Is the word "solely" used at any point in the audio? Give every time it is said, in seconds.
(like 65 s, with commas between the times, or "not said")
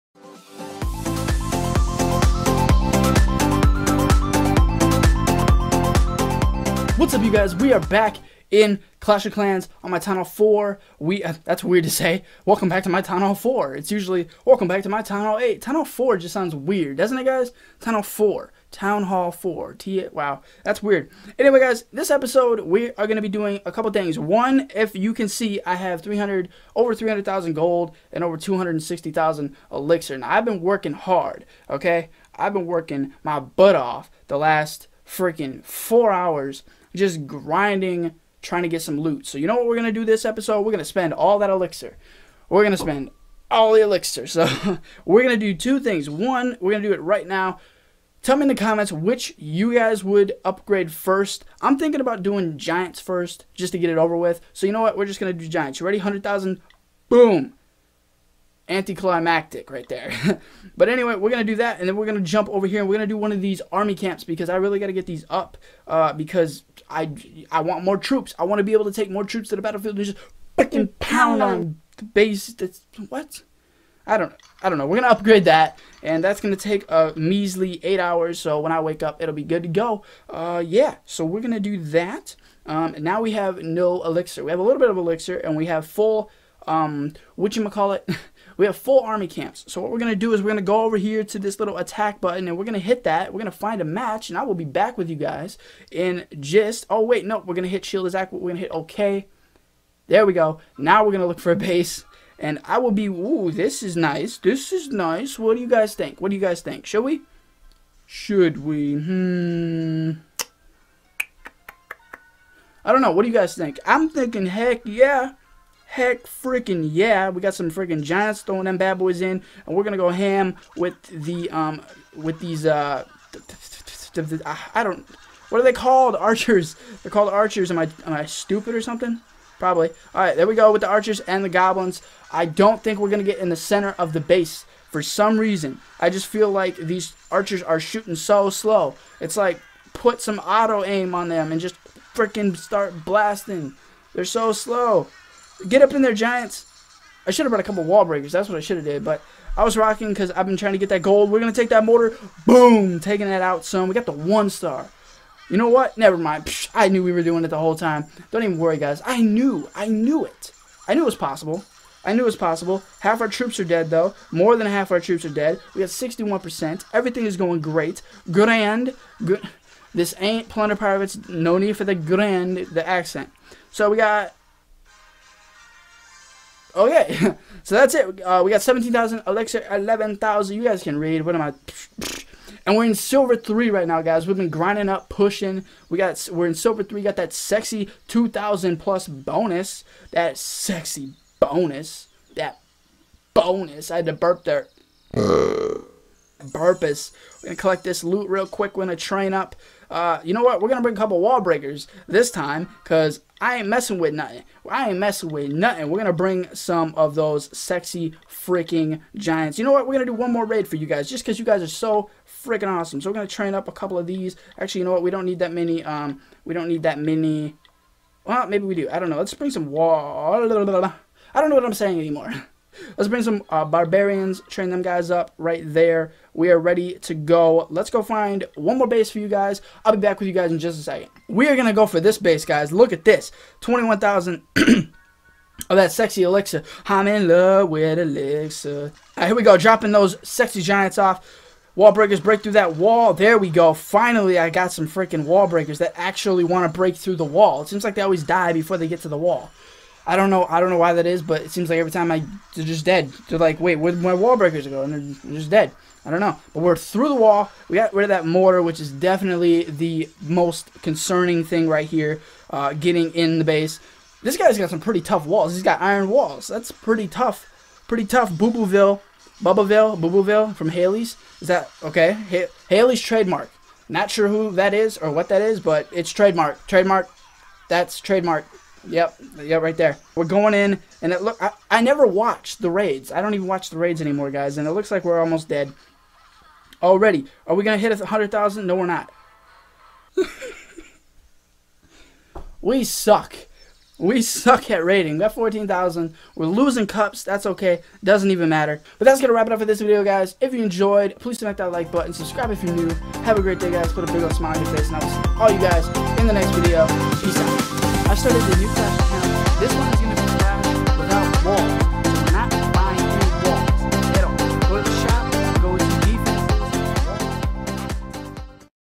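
not said.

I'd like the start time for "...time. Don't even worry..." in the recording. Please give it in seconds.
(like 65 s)
157 s.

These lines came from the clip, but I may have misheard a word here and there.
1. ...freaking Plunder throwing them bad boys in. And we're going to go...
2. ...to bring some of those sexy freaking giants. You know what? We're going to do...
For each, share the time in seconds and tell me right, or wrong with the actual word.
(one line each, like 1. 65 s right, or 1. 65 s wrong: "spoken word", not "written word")
1. 117 s wrong: "Giants", not "Plunder"
2. 206 s right.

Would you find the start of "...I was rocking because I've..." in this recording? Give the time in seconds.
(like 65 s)
149 s.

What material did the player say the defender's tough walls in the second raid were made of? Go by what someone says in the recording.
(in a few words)
Iron.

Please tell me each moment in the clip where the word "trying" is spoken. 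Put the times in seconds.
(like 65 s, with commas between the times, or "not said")
38 s, 150 s.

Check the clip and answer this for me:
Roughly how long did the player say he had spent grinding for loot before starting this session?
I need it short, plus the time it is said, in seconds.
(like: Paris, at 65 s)
4 hours, at 35 s.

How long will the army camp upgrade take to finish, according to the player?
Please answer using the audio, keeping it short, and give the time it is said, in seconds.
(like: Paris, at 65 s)
8 hours, at 77 s.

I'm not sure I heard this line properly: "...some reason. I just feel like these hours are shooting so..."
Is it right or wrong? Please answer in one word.
wrong.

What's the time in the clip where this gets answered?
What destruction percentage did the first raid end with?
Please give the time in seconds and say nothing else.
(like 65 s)
165 s.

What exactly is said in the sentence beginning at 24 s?
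One, if you can see, I have 300, over 300,000 gold and over 260,000 elixir.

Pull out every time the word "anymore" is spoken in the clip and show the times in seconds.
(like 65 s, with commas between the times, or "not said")
221 s, 284 s.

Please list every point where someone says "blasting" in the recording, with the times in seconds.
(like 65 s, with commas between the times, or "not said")
143 s.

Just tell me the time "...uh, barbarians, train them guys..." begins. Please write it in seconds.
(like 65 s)
223 s.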